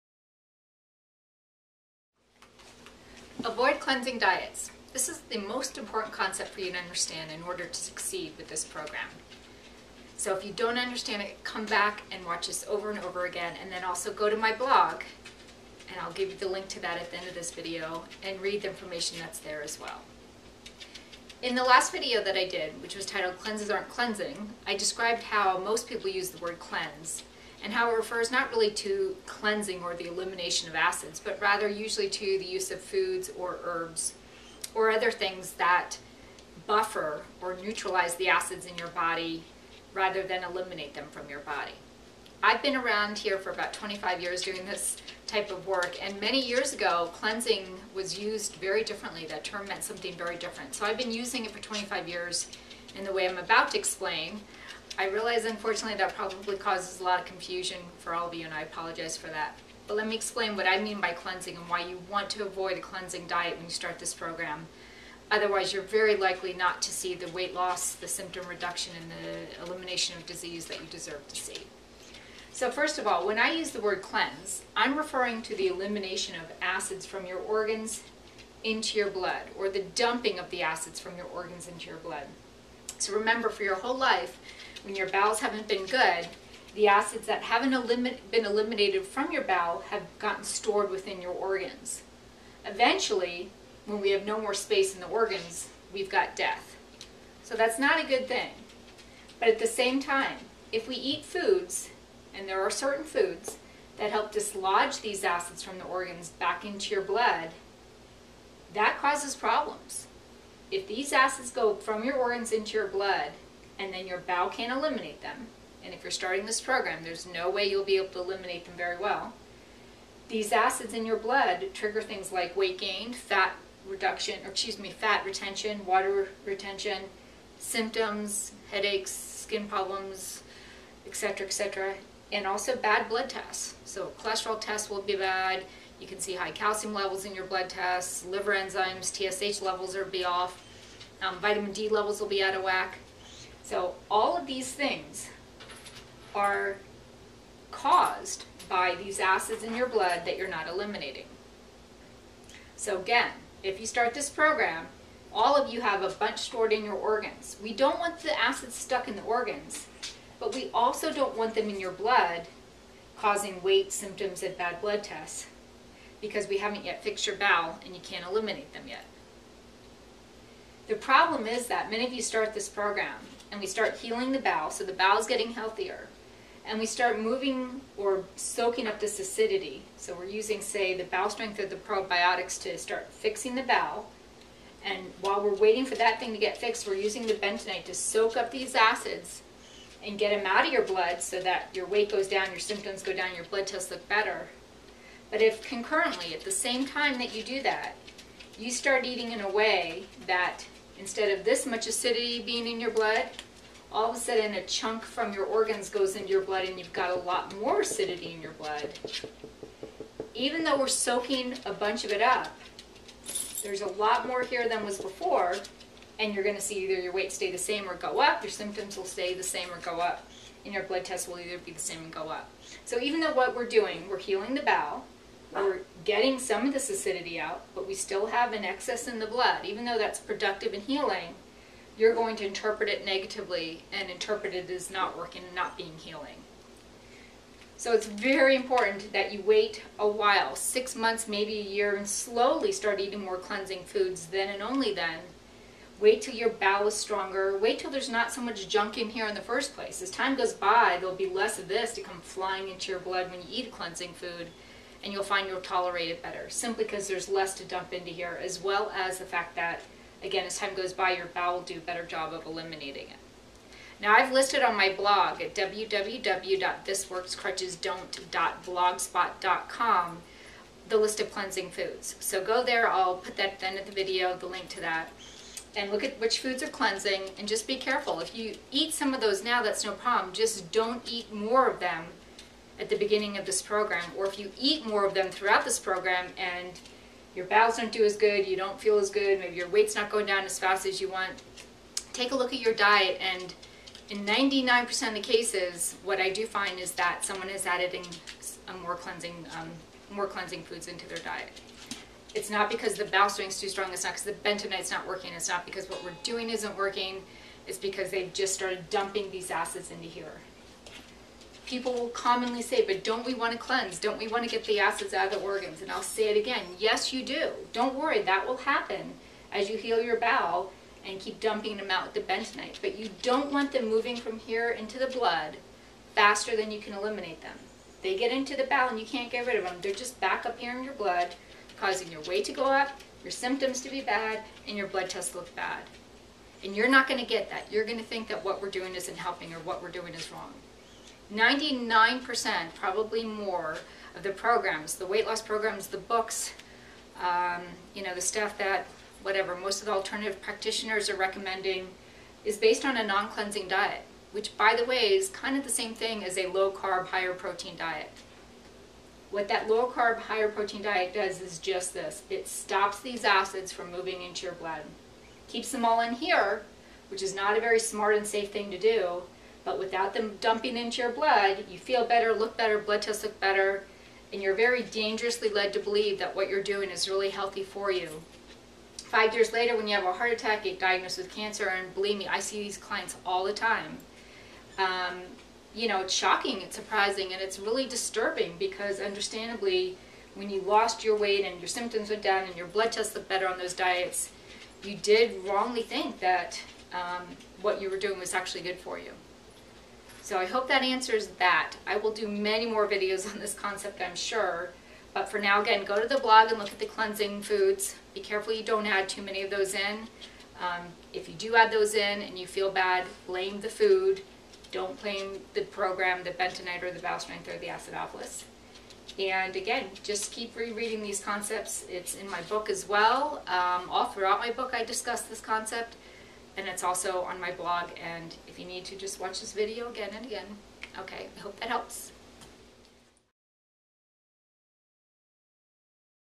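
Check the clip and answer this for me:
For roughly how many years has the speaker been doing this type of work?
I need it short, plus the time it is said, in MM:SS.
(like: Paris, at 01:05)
25 years, at 00:43.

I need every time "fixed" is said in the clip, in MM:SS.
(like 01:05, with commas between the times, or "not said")
02:47, 03:06.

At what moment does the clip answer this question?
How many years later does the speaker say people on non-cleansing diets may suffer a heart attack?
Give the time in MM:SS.
06:18.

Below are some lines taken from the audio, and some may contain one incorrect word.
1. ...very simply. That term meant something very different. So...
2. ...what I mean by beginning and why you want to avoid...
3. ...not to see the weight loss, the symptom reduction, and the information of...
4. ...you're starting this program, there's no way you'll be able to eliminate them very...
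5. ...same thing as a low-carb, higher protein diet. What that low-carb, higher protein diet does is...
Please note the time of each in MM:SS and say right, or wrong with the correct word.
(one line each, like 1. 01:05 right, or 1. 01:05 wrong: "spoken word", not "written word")
1. 00:48 wrong: "differently", not "simply"
2. 01:00 wrong: "cleansing", not "beginning"
3. 01:06 wrong: "elimination", not "information"
4. 01:56 right
5. 05:55 right.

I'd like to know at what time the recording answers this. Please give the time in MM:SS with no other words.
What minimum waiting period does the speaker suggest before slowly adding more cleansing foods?
04:00.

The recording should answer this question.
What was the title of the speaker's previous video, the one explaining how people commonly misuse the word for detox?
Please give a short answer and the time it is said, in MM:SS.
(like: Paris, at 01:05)
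Cleanses Aren't Cleansing, at 00:23.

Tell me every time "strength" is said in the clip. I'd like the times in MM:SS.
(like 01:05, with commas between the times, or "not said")
03:01, 05:03, 06:57.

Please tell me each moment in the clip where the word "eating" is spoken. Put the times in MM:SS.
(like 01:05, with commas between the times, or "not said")
03:19, 04:02.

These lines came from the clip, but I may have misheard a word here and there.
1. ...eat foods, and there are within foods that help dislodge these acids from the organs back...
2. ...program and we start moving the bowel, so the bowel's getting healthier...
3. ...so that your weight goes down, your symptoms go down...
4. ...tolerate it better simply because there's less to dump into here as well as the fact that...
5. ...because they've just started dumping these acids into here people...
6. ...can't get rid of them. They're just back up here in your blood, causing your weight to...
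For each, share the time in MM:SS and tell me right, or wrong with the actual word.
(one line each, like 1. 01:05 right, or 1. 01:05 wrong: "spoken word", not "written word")
1. 01:40 wrong: "certain", not "within"
2. 02:52 wrong: "healing", not "moving"
3. 03:11 right
4. 04:15 right
5. 05:07 right
6. 05:29 right.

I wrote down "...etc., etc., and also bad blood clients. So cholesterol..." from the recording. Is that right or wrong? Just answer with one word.
wrong.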